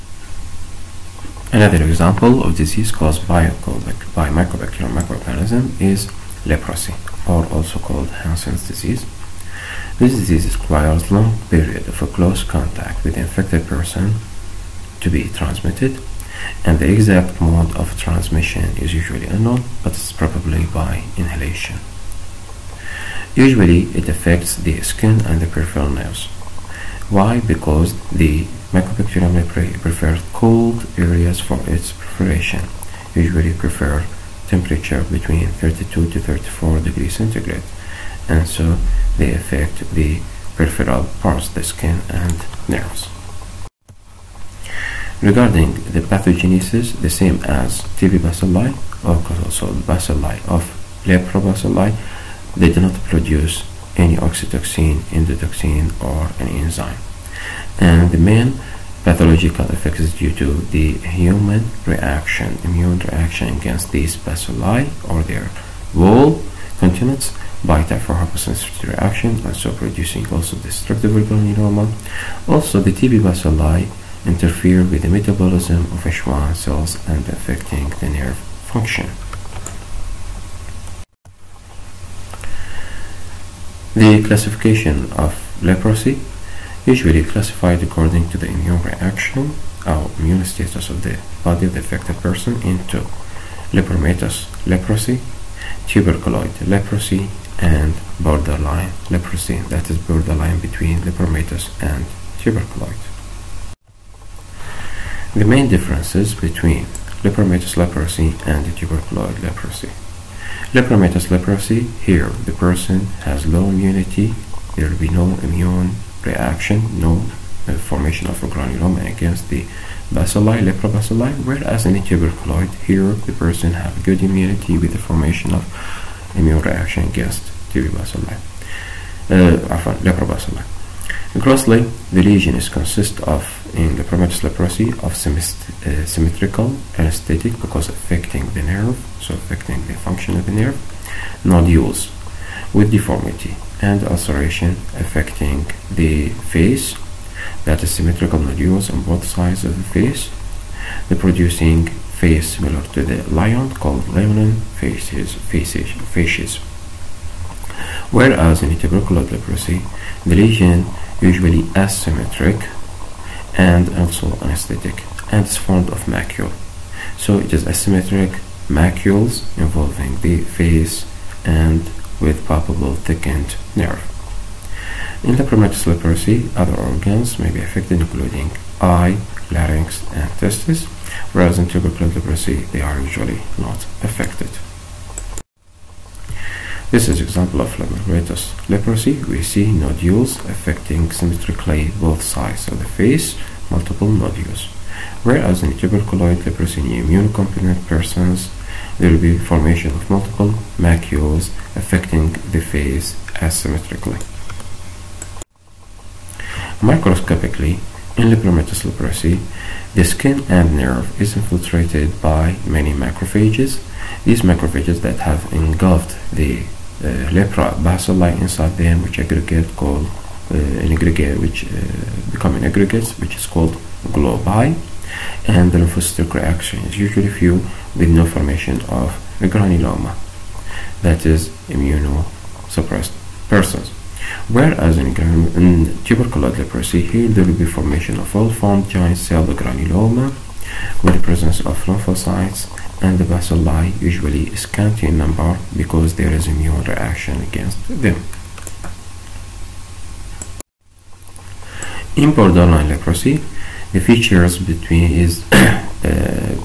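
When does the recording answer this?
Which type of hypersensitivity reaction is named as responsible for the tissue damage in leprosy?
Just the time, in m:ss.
1:07.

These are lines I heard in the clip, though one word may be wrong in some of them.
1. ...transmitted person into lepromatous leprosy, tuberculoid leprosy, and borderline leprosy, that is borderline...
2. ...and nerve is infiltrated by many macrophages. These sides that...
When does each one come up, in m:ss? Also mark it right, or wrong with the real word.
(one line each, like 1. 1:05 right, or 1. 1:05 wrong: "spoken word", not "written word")
1. 1:31 wrong: "affected", not "transmitted"
2. 3:30 wrong: "macrophages", not "sides".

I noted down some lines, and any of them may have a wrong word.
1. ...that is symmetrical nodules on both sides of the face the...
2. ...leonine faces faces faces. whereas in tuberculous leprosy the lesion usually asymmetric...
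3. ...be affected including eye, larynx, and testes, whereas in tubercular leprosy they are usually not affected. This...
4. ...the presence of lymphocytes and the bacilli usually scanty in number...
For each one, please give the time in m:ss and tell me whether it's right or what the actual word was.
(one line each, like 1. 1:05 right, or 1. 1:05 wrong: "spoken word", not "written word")
1. 2:27 right
2. 2:34 right
3. 2:57 right
4. 4:01 right.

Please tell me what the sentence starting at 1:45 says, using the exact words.
The main differences between lepromatous leprosy and tuberculoid leprosy.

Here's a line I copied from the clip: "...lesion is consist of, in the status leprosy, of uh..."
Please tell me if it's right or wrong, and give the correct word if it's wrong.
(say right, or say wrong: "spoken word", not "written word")
wrong: "lepromatous", not "status".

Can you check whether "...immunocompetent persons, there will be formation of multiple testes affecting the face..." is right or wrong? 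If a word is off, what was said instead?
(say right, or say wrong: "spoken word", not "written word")
wrong: "macules", not "testes".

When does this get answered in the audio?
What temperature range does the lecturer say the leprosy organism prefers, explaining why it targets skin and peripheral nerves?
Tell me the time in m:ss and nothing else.
0:35.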